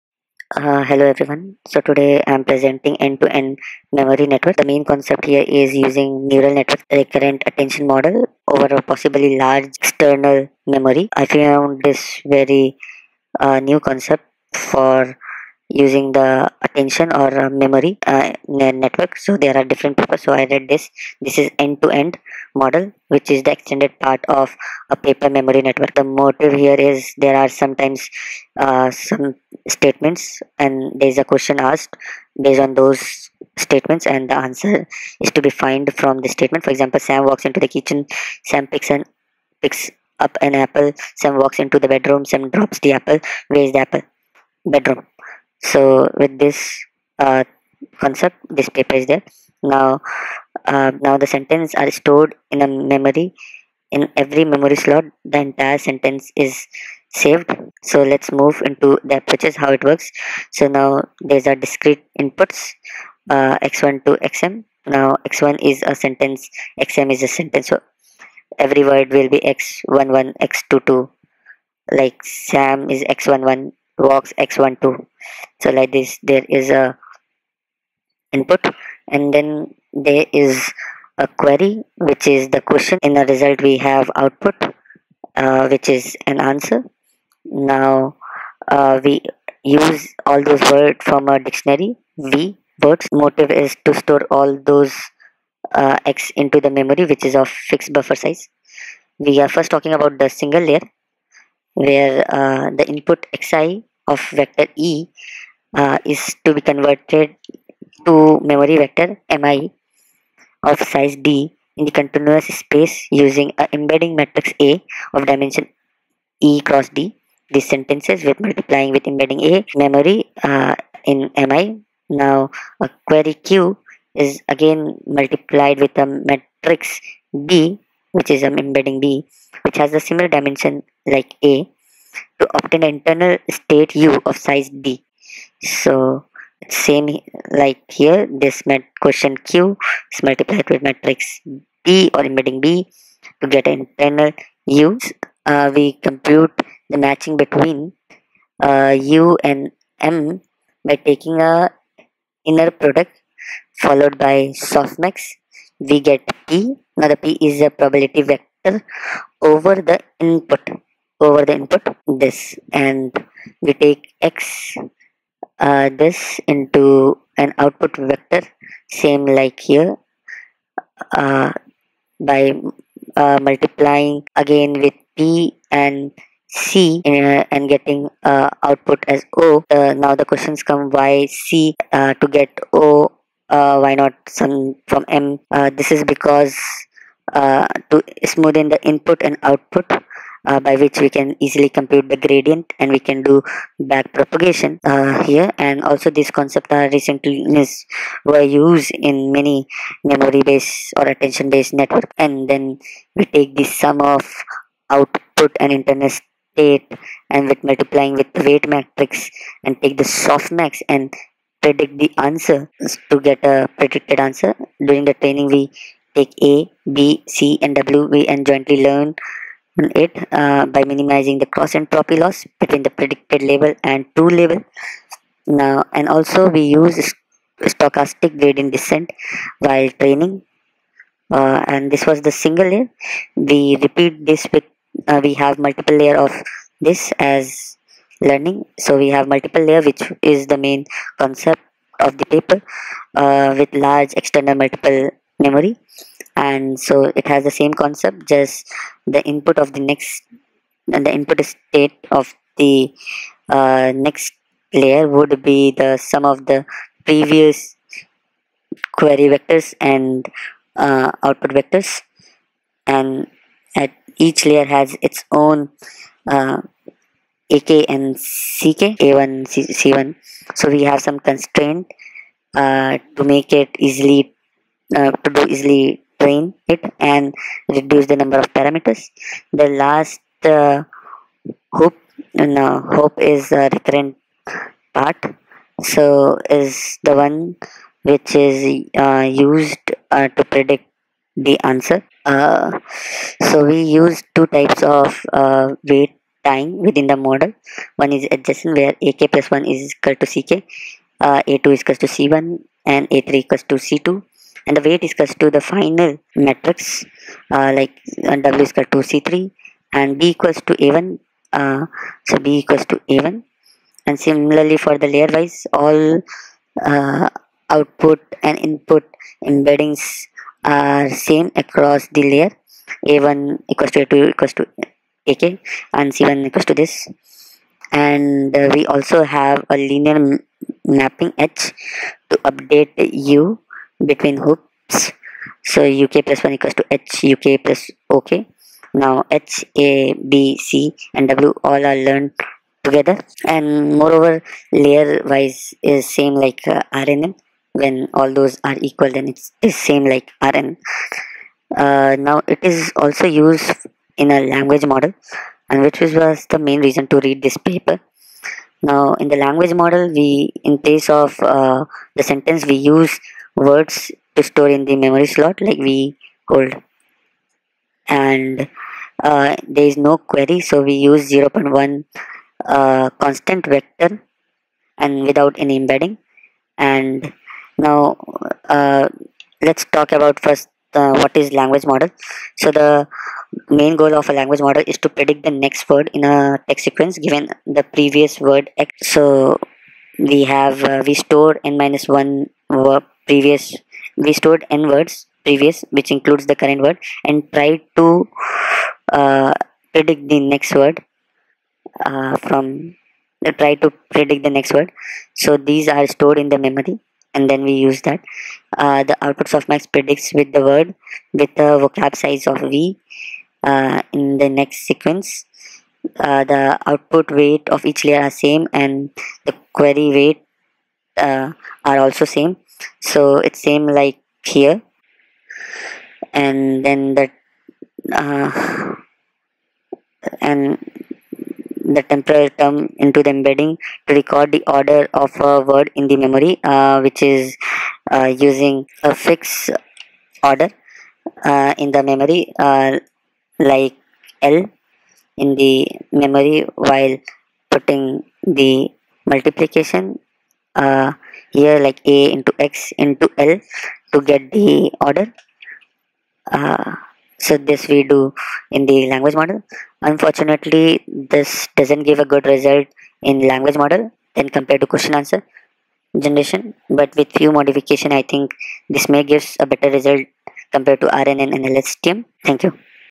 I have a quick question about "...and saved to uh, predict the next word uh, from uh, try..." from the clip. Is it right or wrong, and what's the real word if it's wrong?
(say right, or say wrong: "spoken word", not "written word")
wrong: "tried", not "saved".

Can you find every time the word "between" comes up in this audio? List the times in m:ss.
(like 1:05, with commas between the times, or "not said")
2:27, 3:42, 5:34.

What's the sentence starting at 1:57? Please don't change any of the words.
These sentences with multiplying with embedding A memory uh, in Mi.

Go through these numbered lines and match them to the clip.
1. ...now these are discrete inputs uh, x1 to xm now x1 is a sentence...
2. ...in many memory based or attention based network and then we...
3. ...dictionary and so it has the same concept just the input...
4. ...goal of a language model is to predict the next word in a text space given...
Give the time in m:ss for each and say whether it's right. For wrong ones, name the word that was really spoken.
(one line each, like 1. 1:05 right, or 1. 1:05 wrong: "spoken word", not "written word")
1. 1:00 right
2. 3:18 right
3. 4:05 wrong: "memory", not "dictionary"
4. 6:23 wrong: "sequence", not "space".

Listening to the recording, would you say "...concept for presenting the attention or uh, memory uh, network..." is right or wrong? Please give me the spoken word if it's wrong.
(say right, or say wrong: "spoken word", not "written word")
wrong: "using", not "presenting".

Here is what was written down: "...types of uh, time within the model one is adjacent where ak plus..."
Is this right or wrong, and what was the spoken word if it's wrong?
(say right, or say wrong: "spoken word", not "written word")
right.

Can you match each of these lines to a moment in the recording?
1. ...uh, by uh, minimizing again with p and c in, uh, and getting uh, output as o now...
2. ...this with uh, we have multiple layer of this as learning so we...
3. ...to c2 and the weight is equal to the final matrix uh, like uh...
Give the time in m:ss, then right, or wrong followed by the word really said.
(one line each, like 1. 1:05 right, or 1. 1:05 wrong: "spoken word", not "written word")
1. 2:51 wrong: "multiplying", not "minimizing"
2. 3:54 right
3. 5:03 right.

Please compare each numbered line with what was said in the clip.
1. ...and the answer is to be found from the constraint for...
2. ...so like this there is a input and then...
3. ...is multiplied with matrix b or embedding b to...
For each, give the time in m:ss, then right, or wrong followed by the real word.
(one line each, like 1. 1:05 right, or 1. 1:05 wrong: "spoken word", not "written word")
1. 0:34 wrong: "statement", not "constraint"
2. 1:15 right
3. 2:20 right.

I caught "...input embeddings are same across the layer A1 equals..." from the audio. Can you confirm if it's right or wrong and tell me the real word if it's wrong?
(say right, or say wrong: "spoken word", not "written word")
right.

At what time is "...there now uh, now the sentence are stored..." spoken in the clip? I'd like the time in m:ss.
0:49.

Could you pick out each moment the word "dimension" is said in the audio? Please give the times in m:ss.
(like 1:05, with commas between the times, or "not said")
1:55, 2:10.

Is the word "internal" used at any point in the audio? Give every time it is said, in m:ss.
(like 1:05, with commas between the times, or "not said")
2:12, 2:23, 3:25.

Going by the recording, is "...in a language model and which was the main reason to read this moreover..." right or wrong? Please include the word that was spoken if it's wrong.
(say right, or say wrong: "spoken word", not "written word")
wrong: "paper", not "moreover".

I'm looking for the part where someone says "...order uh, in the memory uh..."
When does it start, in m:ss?
7:20.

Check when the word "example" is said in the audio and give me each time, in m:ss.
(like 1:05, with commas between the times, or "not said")
0:36.